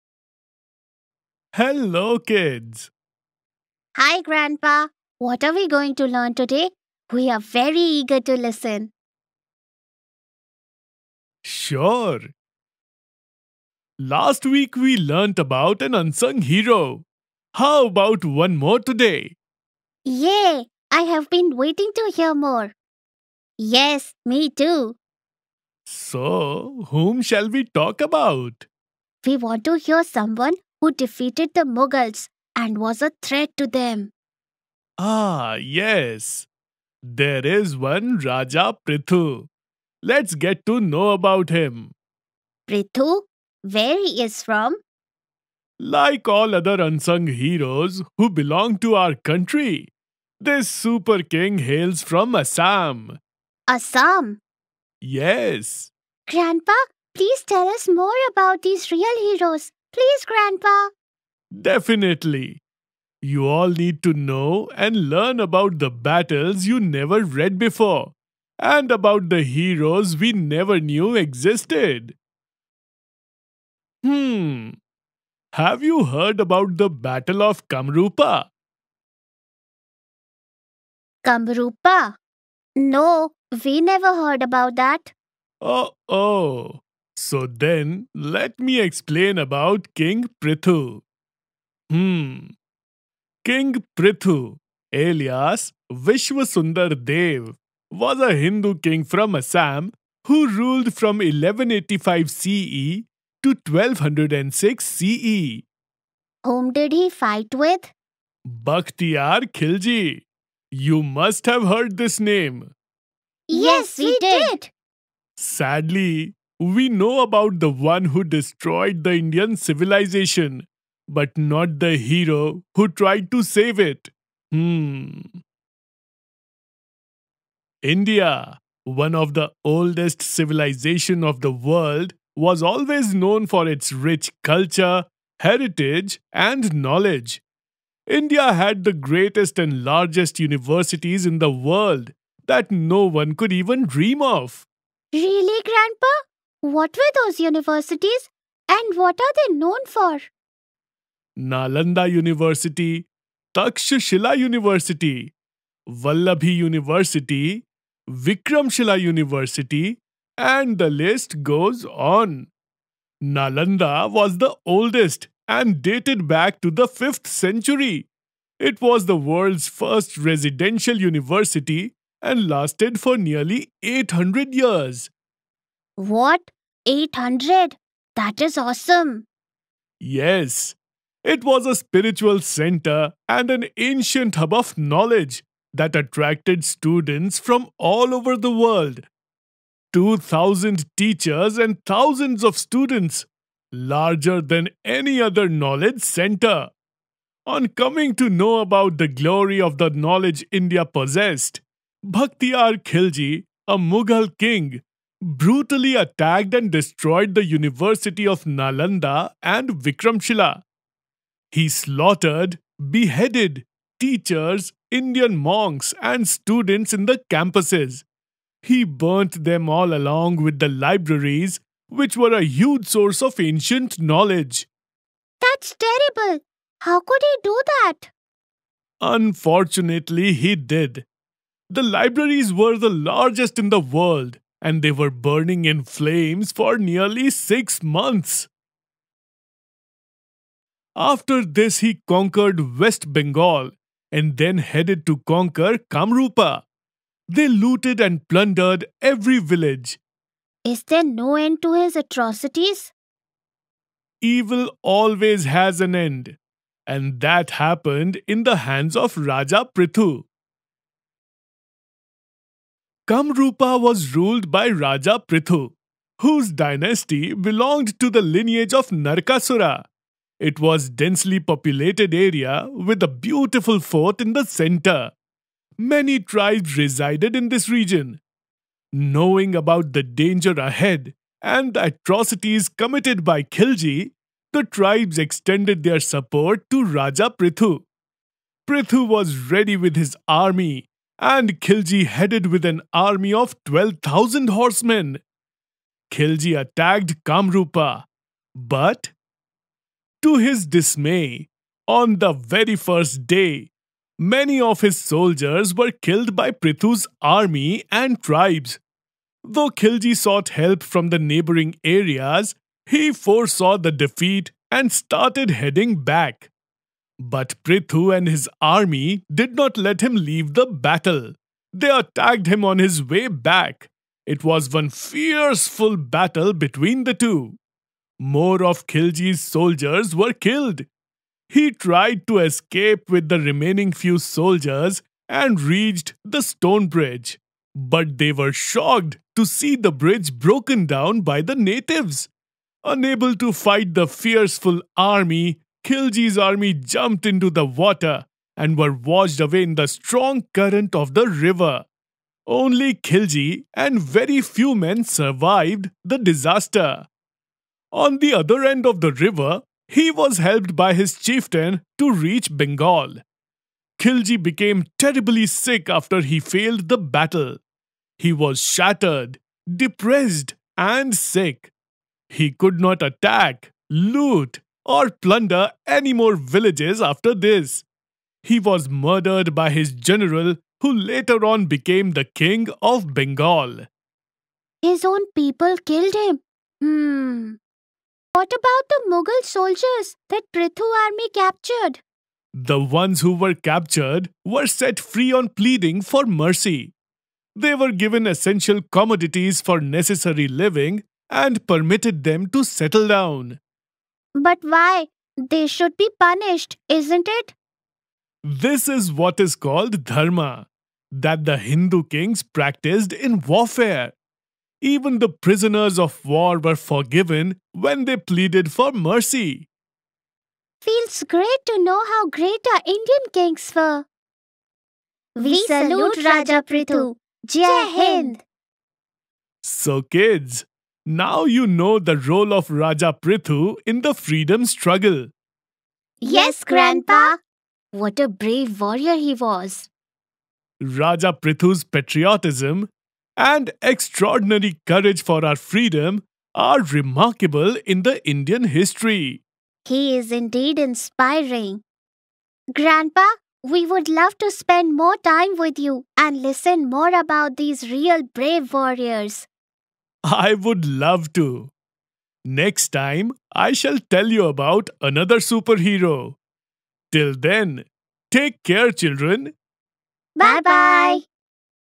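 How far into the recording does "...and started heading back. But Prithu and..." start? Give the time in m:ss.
5:14.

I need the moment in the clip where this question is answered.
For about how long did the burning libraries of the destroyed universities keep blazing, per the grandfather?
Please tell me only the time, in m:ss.
3:57.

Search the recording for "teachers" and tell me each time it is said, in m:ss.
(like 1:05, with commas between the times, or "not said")
3:10, 3:33.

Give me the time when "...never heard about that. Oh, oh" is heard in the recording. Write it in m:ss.
1:23.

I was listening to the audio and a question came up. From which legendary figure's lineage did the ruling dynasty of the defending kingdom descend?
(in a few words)
Narkasura.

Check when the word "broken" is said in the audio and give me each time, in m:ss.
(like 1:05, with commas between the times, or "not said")
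5:40.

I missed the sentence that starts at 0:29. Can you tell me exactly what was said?
We want to hear someone who defeated the Mughals and was a threat to them.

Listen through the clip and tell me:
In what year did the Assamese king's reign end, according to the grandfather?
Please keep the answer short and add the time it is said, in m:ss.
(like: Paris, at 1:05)
1206 CE, at 1:43.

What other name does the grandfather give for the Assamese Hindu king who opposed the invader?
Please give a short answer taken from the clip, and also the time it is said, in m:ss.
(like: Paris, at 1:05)
Vishwasundar Dev, at 1:35.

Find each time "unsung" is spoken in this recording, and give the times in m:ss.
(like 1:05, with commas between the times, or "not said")
0:15, 0:46.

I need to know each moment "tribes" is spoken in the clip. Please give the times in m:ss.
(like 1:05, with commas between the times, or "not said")
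4:36, 4:44, 5:08.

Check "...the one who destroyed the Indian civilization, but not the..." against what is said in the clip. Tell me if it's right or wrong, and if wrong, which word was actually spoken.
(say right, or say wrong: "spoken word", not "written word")
right.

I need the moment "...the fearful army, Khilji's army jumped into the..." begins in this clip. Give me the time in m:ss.
5:43.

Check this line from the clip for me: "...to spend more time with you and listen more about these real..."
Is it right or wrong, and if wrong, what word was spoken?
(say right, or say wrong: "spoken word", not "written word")
right.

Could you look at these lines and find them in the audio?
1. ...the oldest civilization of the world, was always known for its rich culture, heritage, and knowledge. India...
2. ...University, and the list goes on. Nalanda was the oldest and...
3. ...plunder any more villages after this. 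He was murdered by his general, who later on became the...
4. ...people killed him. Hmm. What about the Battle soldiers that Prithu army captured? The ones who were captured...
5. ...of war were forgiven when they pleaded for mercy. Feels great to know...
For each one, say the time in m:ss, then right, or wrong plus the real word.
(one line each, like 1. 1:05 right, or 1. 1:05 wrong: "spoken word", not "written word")
1. 2:09 right
2. 2:39 right
3. 6:15 right
4. 6:25 wrong: "Mughal", not "Battle"
5. 6:55 right.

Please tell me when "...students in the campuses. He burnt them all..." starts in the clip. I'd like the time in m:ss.
3:36.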